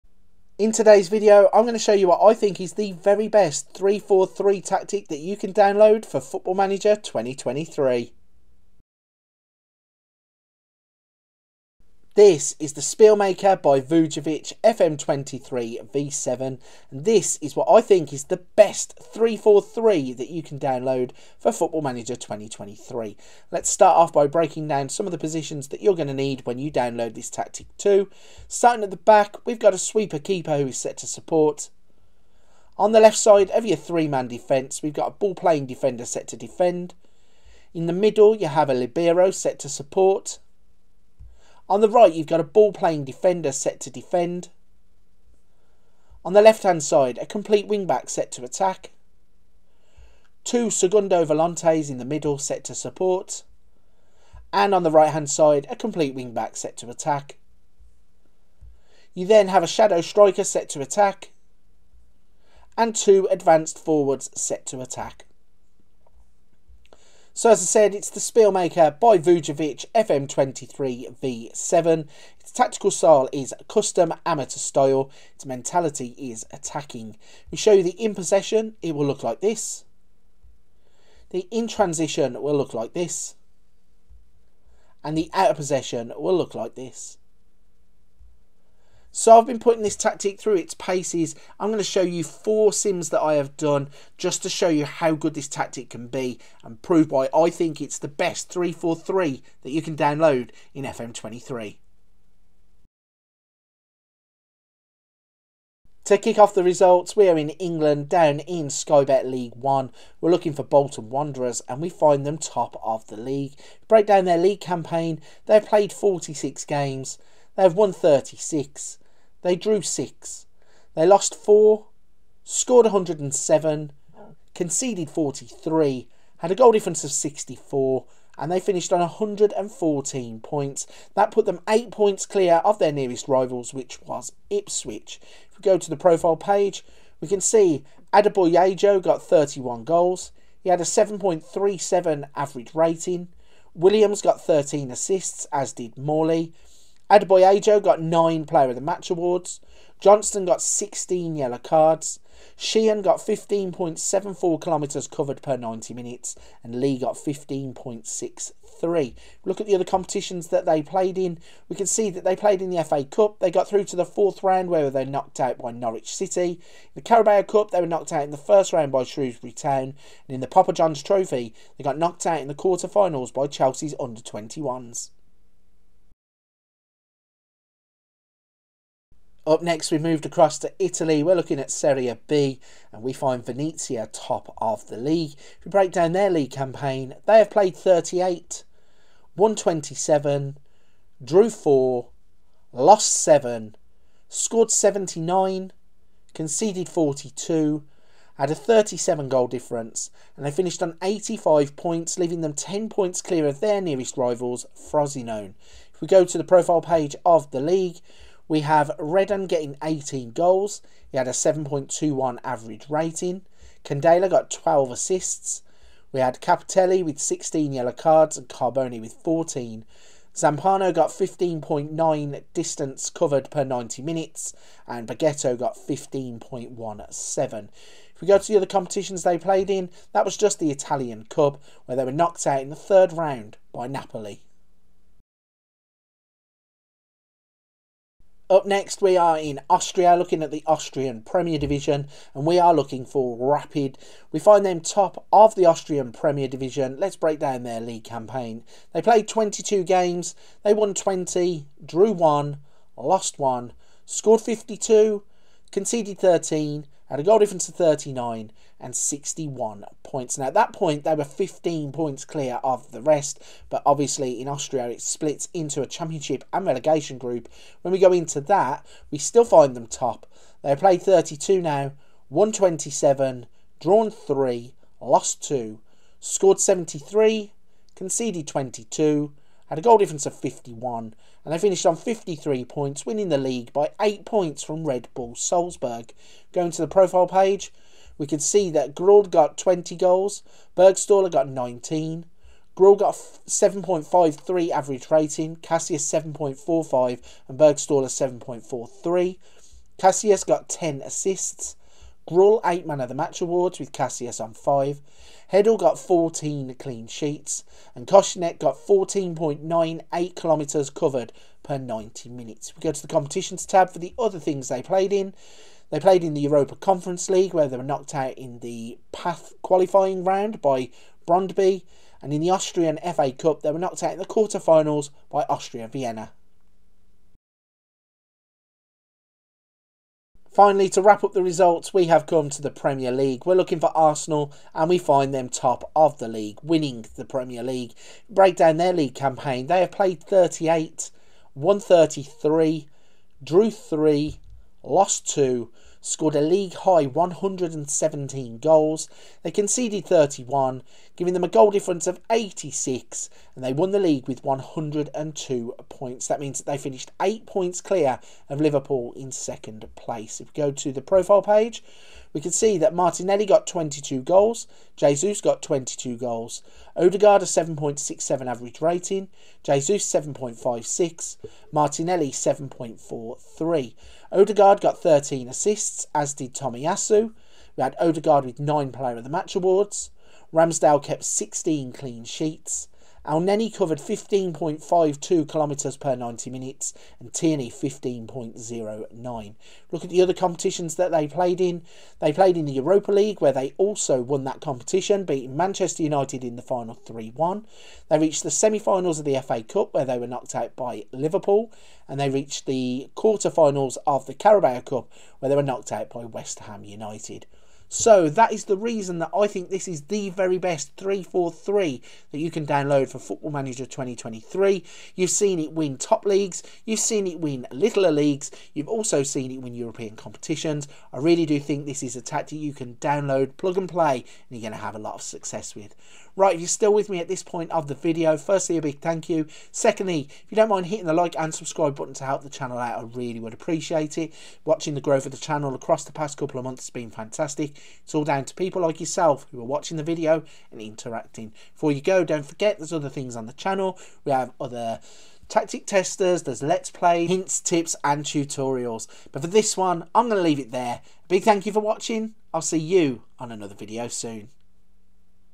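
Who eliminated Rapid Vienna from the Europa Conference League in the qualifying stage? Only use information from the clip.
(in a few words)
Brondby.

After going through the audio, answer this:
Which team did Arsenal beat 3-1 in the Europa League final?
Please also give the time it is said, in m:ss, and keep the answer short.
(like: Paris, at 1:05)
Manchester United, at 6:35.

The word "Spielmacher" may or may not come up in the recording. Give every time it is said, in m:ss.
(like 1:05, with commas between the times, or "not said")
0:12, 1:08.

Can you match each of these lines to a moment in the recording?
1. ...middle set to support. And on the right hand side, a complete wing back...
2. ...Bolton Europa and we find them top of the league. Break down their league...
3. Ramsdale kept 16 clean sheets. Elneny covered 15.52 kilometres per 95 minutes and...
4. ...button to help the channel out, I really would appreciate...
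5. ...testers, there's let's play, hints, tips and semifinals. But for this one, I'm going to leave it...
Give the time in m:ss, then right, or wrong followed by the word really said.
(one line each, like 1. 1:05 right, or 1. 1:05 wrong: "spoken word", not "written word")
1. 0:52 right
2. 1:50 wrong: "Wanderers", not "Europa"
3. 6:20 wrong: "90", not "95"
4. 7:11 right
5. 7:25 wrong: "tutorials", not "semifinals".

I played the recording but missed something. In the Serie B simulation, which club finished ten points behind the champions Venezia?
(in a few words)
Frosinone.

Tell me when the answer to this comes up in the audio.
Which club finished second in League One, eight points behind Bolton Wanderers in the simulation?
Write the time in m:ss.
2:14.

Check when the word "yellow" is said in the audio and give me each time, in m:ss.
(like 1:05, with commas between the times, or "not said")
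2:31, 3:37.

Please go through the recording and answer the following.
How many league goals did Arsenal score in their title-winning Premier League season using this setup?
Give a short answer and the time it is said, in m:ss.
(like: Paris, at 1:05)
117, at 5:47.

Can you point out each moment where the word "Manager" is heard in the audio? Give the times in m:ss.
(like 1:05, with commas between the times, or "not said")
0:06, 0:21, 6:53.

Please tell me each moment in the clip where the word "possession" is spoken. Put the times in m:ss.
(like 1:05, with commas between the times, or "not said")
1:18, 1:25.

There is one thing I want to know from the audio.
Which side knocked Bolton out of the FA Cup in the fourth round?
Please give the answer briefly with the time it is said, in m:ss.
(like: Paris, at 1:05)
Norwich City, at 2:45.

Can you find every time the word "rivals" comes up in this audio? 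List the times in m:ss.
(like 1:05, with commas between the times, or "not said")
2:13, 3:24.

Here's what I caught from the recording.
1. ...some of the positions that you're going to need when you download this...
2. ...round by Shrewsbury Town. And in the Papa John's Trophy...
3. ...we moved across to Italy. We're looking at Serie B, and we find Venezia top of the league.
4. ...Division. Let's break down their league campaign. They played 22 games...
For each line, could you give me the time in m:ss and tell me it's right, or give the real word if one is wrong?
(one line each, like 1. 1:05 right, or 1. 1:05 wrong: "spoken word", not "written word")
1. 0:24 right
2. 2:48 right
3. 2:59 right
4. 4:06 right.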